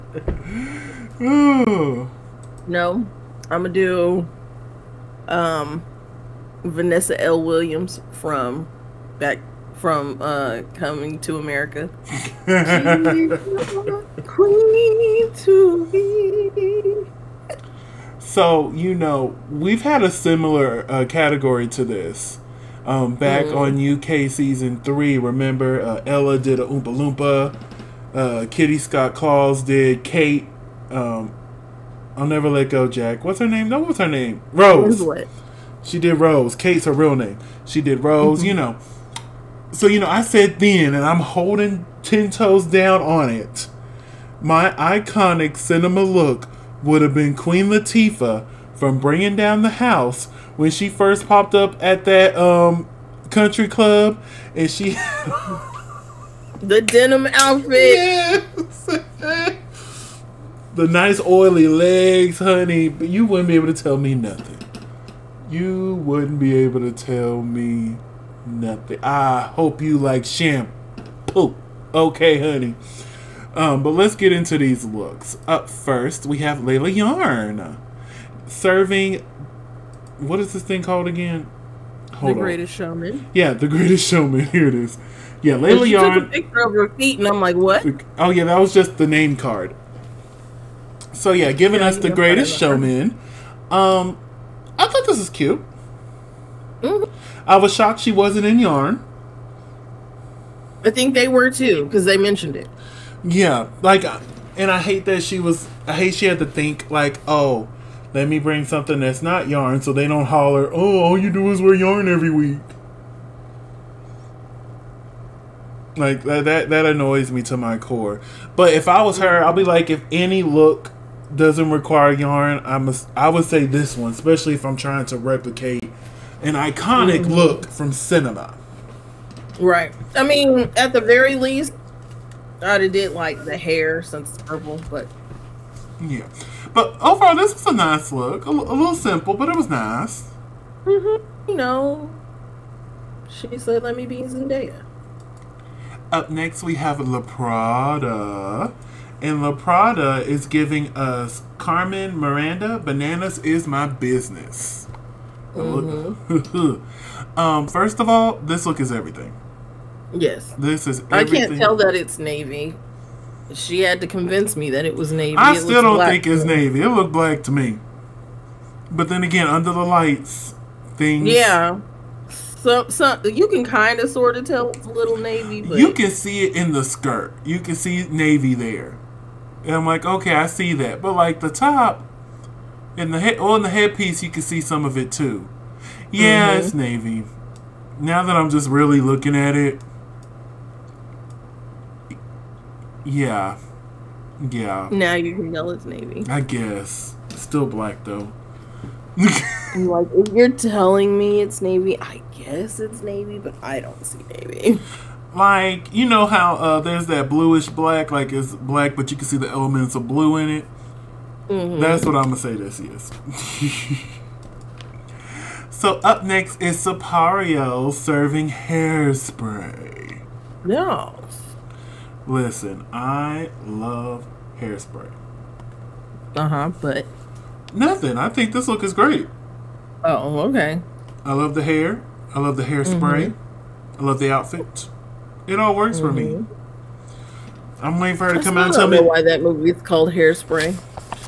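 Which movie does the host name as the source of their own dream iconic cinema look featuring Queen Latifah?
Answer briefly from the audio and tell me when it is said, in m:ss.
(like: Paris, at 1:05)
Bringing Down the House, at 0:48.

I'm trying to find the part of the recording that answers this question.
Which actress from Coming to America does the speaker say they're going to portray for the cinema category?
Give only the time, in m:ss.
0:06.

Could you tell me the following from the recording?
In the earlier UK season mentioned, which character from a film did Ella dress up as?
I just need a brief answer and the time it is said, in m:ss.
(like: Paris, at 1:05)
Oompa Loompa, at 0:26.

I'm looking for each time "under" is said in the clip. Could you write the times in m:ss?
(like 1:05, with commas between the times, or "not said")
2:49.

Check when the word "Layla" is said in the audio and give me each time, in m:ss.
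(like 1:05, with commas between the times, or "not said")
1:16, 1:25.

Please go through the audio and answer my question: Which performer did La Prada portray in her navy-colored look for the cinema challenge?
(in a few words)
Carmen Miranda.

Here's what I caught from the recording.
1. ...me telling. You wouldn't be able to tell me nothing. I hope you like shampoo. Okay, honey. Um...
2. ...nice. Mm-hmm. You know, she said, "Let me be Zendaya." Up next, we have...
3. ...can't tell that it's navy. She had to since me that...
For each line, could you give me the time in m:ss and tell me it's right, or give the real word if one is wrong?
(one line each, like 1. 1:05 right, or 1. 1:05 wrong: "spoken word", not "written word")
1. 1:03 wrong: "nothing", not "telling"
2. 2:19 right
3. 2:41 wrong: "convince", not "since".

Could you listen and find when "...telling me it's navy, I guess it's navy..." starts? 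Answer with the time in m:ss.
3:20.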